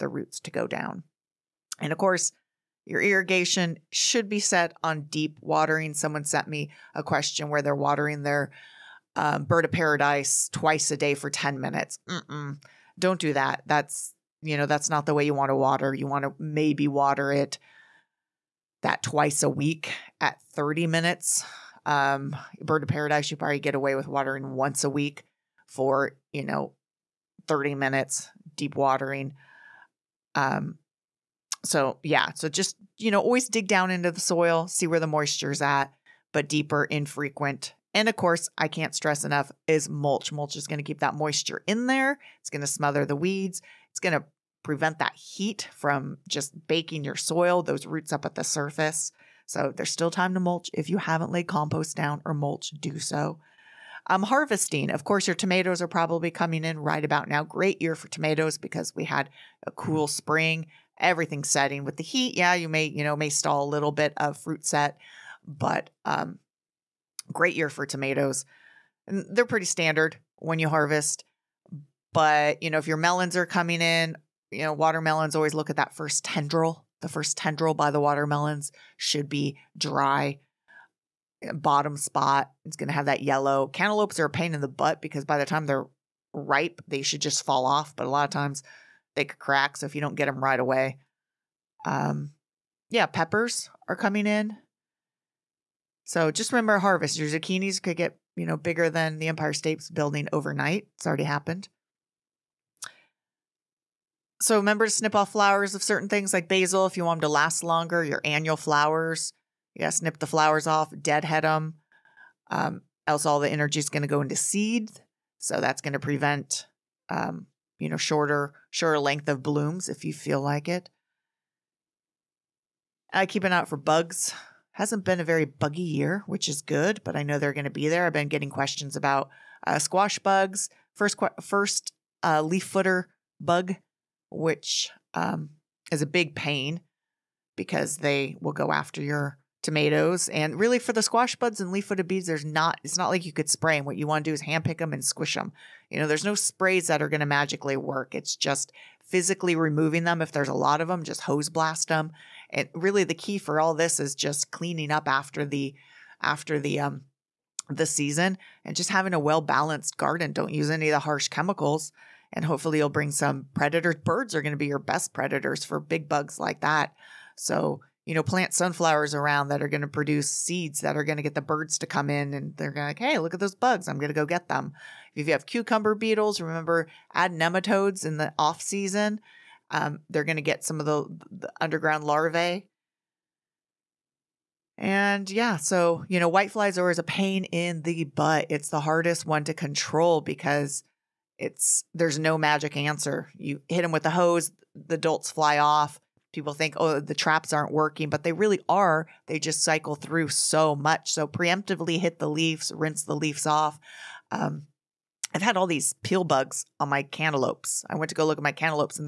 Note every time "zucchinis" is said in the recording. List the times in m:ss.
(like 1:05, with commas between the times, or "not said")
1:37.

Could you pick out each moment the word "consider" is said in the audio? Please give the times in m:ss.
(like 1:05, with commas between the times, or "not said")
not said.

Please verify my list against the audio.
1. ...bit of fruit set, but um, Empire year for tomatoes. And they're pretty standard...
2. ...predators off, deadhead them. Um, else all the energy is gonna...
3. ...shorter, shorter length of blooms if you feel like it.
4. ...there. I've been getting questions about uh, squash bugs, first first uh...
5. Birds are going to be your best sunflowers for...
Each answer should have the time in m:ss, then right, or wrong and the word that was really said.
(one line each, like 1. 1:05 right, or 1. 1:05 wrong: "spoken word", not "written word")
1. 1:03 wrong: "Great", not "Empire"
2. 1:50 wrong: "flowers", not "predators"
3. 1:57 right
4. 2:07 right
5. 2:44 wrong: "predators", not "sunflowers".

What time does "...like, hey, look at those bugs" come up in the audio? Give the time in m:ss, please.
2:53.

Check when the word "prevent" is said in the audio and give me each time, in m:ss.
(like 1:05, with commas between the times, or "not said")
0:44, 1:55.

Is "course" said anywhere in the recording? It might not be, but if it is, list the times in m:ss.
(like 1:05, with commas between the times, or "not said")
0:01, 0:38, 0:55.